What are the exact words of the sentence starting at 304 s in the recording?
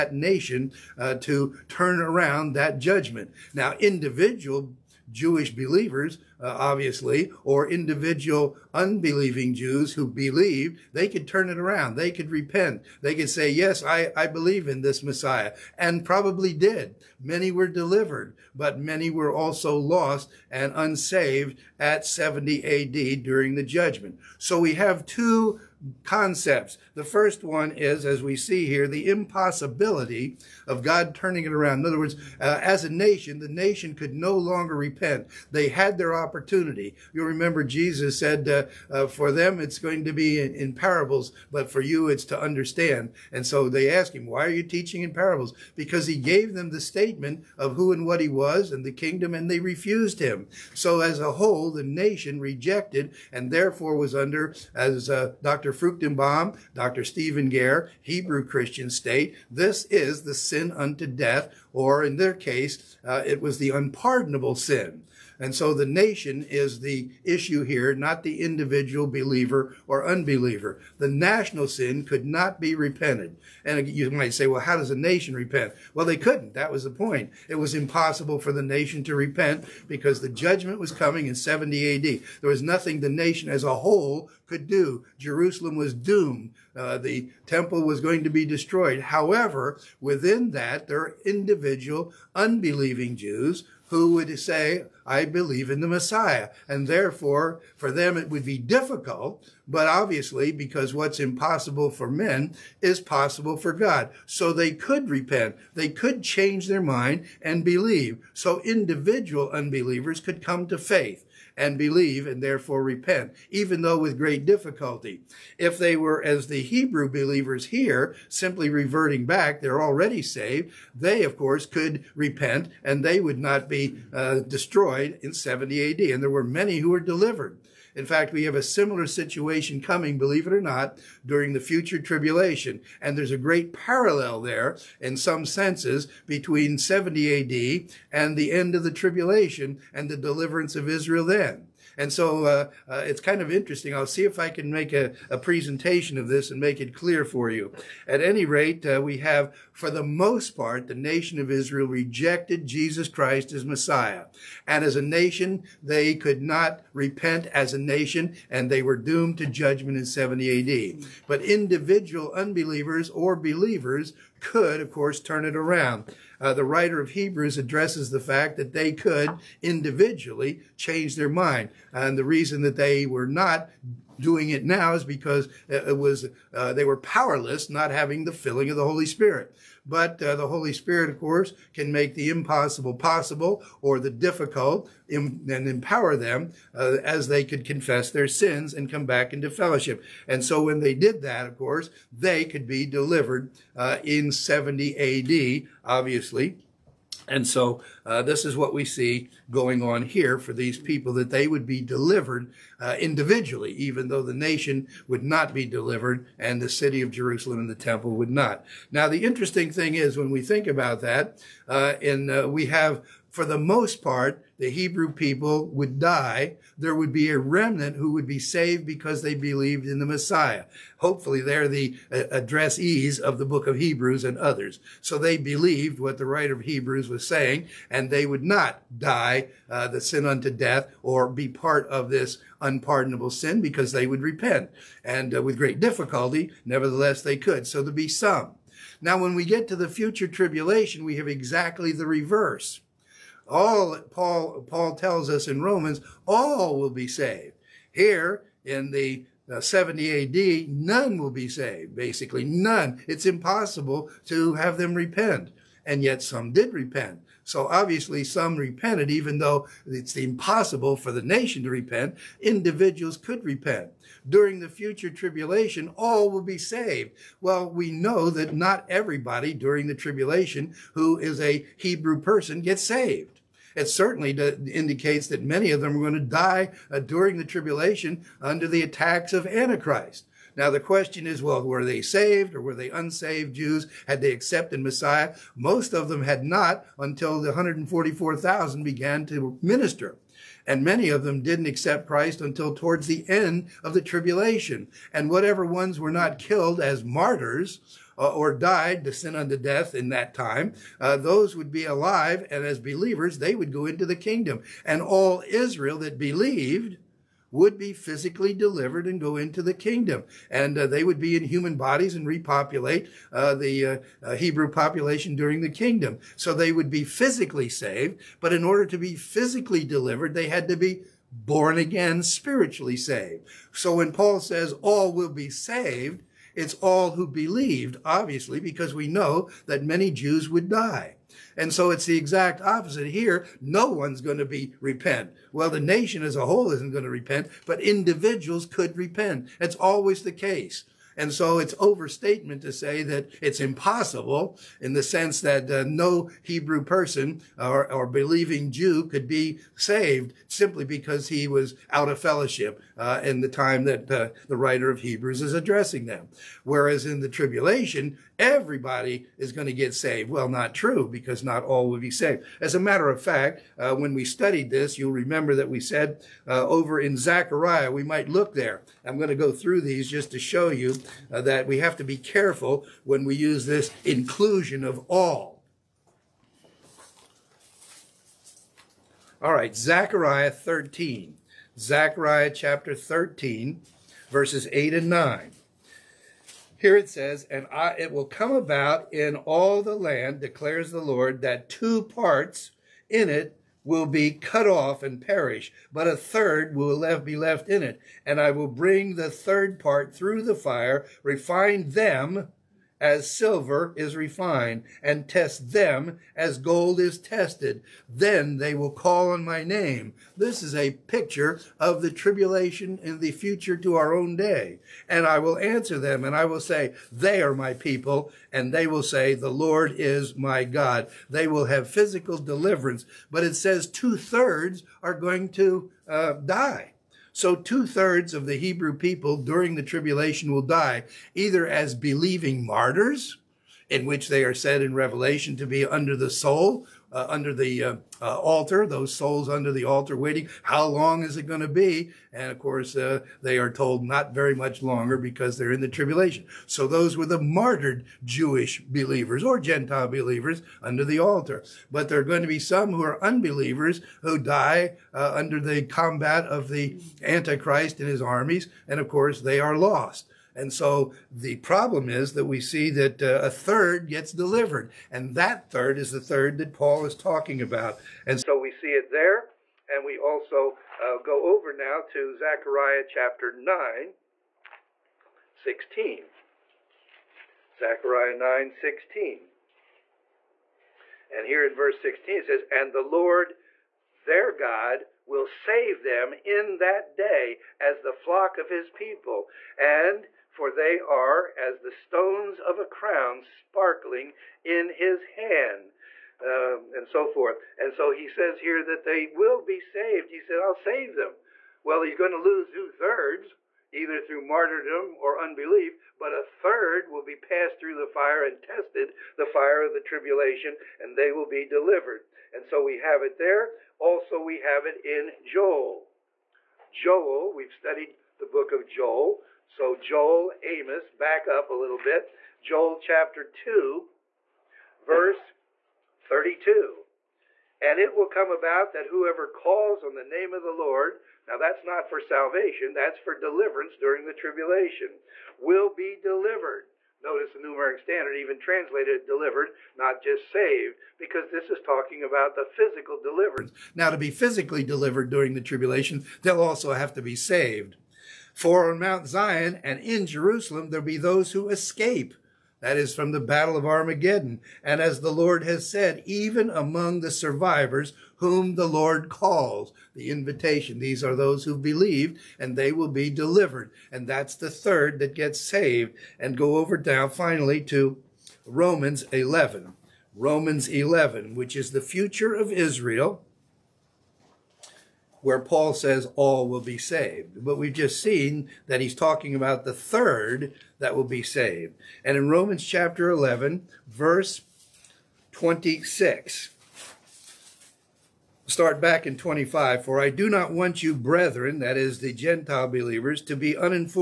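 And all Israel that believed would be physically delivered and go into the kingdom.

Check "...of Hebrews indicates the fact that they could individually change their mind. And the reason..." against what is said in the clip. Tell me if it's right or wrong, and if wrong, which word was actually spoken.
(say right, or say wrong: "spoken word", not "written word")
wrong: "addresses", not "indicates".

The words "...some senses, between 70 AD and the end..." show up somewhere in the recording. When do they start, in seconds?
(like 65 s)
135 s.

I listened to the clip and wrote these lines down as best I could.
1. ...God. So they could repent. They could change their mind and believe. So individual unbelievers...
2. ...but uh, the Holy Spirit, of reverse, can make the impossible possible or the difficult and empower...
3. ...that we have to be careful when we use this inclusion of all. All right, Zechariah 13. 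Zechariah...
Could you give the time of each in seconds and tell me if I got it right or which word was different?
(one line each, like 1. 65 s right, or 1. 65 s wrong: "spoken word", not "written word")
1. 103 s right
2. 179 s wrong: "course", not "reverse"
3. 371 s right.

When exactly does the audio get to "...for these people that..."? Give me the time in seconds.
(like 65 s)
200 s.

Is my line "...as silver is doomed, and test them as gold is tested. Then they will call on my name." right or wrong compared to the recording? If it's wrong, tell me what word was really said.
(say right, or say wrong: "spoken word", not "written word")
wrong: "refined", not "doomed".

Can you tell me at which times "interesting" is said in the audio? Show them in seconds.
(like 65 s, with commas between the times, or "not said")
143 s, 209 s.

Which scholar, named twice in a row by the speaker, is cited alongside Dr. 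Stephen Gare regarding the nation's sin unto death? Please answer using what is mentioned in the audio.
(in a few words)
Dr. Fruchtenbaum.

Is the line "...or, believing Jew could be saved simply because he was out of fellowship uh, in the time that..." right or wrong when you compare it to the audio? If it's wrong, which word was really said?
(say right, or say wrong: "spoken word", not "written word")
right.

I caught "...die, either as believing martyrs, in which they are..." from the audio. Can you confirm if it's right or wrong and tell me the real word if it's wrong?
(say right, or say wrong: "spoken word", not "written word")
right.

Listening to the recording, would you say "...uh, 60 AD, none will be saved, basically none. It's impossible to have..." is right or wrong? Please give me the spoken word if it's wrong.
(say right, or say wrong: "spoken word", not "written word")
wrong: "70", not "60".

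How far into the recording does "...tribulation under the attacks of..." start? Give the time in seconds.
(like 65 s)
277 s.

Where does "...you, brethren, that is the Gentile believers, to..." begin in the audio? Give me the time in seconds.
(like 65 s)
591 s.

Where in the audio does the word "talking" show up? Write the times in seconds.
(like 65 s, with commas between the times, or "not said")
467 s, 541 s, 579 s.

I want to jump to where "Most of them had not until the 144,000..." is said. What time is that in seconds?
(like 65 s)
285 s.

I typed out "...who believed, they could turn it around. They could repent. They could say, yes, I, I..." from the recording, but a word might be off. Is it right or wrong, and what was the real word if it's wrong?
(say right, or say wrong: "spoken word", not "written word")
right.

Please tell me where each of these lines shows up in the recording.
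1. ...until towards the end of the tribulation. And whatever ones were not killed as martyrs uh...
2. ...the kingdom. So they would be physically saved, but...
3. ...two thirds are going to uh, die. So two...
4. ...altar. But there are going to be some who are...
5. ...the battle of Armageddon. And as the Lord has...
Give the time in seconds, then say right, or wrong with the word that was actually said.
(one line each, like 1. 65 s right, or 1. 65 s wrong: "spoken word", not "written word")
1. 292 s right
2. 315 s right
3. 423 s right
4. 451 s right
5. 553 s right.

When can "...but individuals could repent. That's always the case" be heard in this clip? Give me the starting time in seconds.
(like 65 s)
337 s.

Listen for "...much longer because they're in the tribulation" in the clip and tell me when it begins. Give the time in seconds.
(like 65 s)
444 s.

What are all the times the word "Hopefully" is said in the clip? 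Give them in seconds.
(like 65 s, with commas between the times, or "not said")
220 s.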